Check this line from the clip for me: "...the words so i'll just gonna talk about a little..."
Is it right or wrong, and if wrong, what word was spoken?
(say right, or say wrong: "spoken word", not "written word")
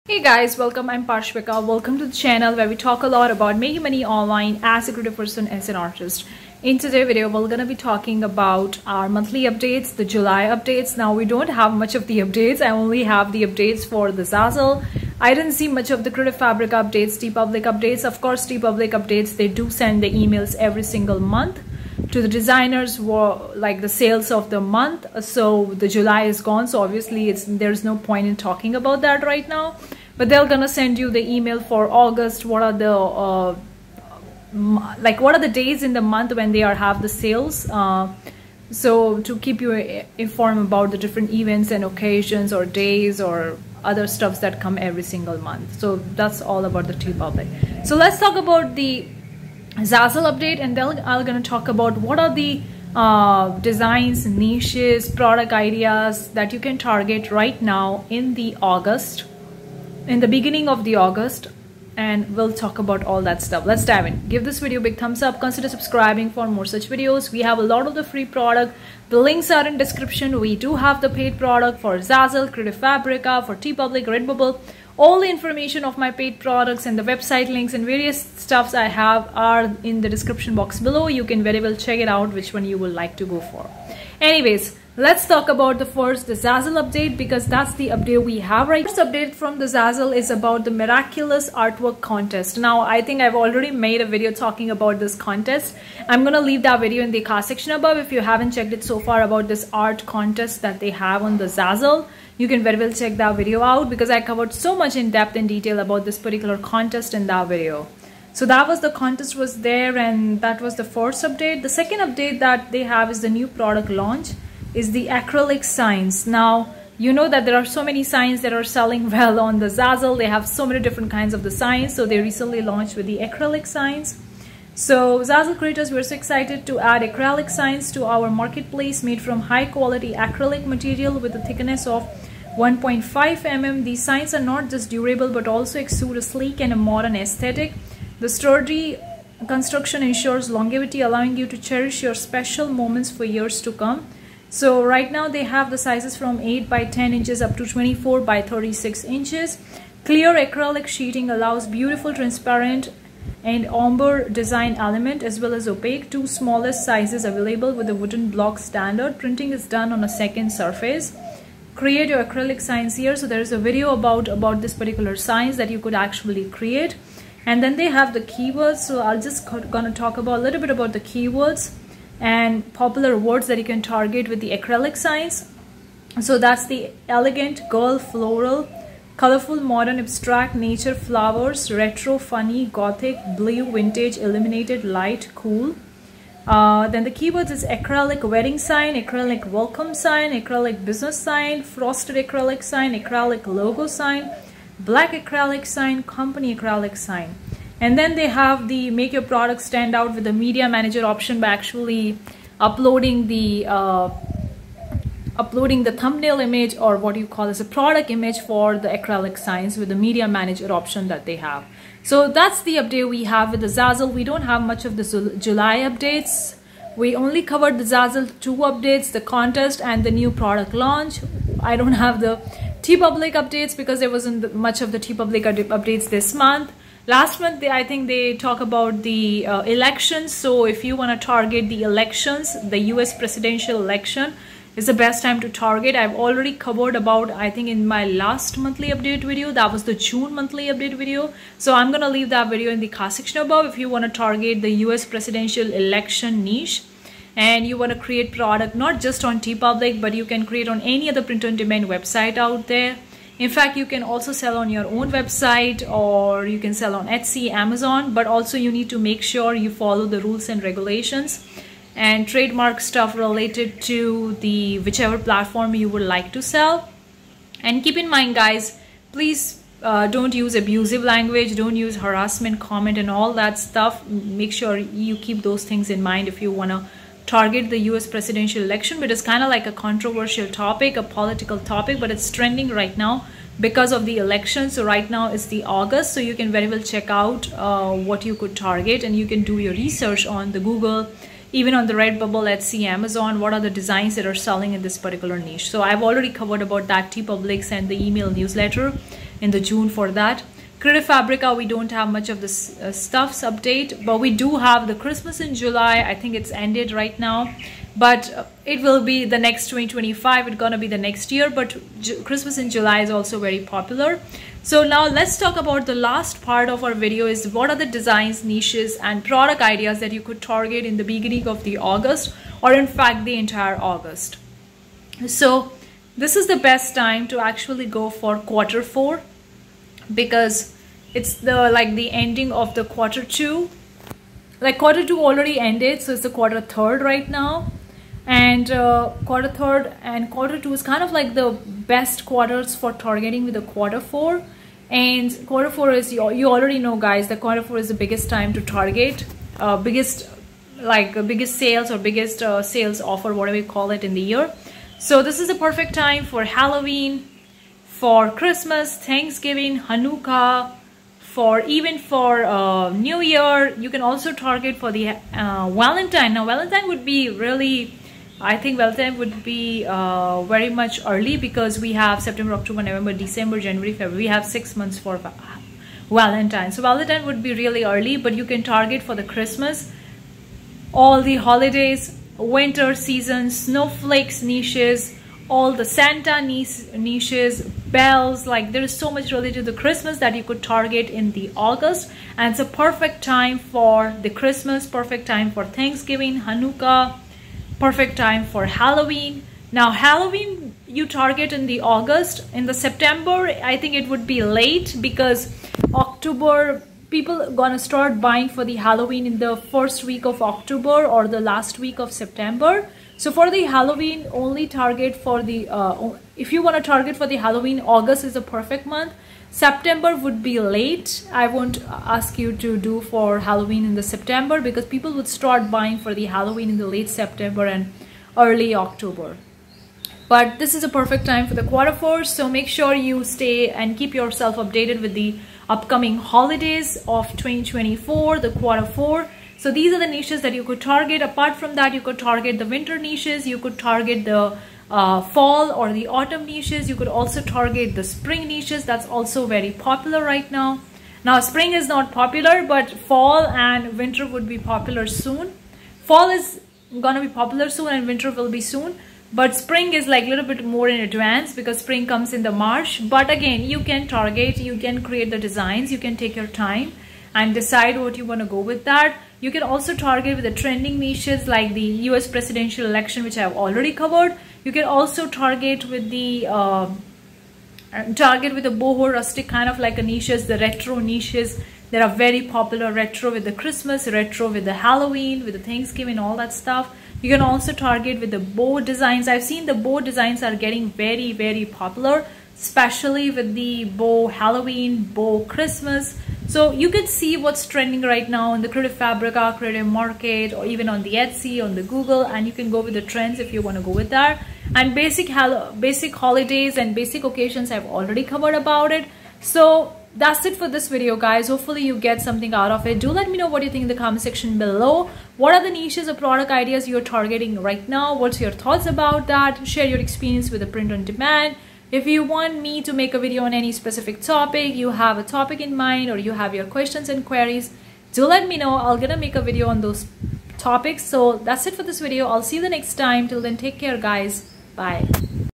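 wrong: "keywords", not "words".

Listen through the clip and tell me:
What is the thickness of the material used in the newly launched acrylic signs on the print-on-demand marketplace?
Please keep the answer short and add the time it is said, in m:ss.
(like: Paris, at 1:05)
1.5 mm, at 2:12.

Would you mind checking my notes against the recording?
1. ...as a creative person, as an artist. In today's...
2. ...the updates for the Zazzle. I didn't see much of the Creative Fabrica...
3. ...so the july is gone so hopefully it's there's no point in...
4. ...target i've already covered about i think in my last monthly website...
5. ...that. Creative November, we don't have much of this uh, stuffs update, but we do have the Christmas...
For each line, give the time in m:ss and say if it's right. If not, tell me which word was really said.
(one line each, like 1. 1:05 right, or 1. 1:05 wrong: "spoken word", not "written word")
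1. 0:04 right
2. 0:13 right
3. 0:25 wrong: "obviously", not "hopefully"
4. 3:55 wrong: "update", not "website"
5. 5:00 wrong: "Fabrica", not "November".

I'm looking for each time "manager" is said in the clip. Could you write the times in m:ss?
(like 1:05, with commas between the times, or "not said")
3:20, 3:30.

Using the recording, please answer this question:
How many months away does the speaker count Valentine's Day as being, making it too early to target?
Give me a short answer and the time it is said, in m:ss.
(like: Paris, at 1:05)
6, at 6:14.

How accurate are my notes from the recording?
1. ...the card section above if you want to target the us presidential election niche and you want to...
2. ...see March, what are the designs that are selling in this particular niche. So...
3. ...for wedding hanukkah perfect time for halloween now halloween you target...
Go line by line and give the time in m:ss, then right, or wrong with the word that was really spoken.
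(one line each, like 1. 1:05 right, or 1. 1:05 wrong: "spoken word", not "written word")
1. 4:02 right
2. 4:52 wrong: "Amazon", not "March"
3. 6:35 wrong: "thanksgiving", not "wedding".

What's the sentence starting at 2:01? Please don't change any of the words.
So they recently launched with the acrylic signs.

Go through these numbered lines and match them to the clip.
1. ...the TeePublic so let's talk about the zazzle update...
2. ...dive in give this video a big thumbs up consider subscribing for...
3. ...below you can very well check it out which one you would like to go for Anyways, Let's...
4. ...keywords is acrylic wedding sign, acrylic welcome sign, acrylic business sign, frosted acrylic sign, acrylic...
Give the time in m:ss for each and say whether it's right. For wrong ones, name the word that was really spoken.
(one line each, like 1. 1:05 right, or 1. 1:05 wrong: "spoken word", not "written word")
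1. 0:46 right
2. 1:03 right
3. 1:20 right
4. 3:07 right.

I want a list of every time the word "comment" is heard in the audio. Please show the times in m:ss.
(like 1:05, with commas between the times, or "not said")
4:32, 8:33.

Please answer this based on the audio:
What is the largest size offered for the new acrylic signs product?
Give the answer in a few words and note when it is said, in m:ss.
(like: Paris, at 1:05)
24 by 36 inches, at 2:27.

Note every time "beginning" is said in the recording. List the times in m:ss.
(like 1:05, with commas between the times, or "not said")
1:00, 5:21.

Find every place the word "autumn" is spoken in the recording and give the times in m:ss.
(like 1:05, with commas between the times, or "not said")
7:26.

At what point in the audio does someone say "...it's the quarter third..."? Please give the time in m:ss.
5:36.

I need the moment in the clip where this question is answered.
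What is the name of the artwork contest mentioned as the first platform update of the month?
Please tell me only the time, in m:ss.
1:30.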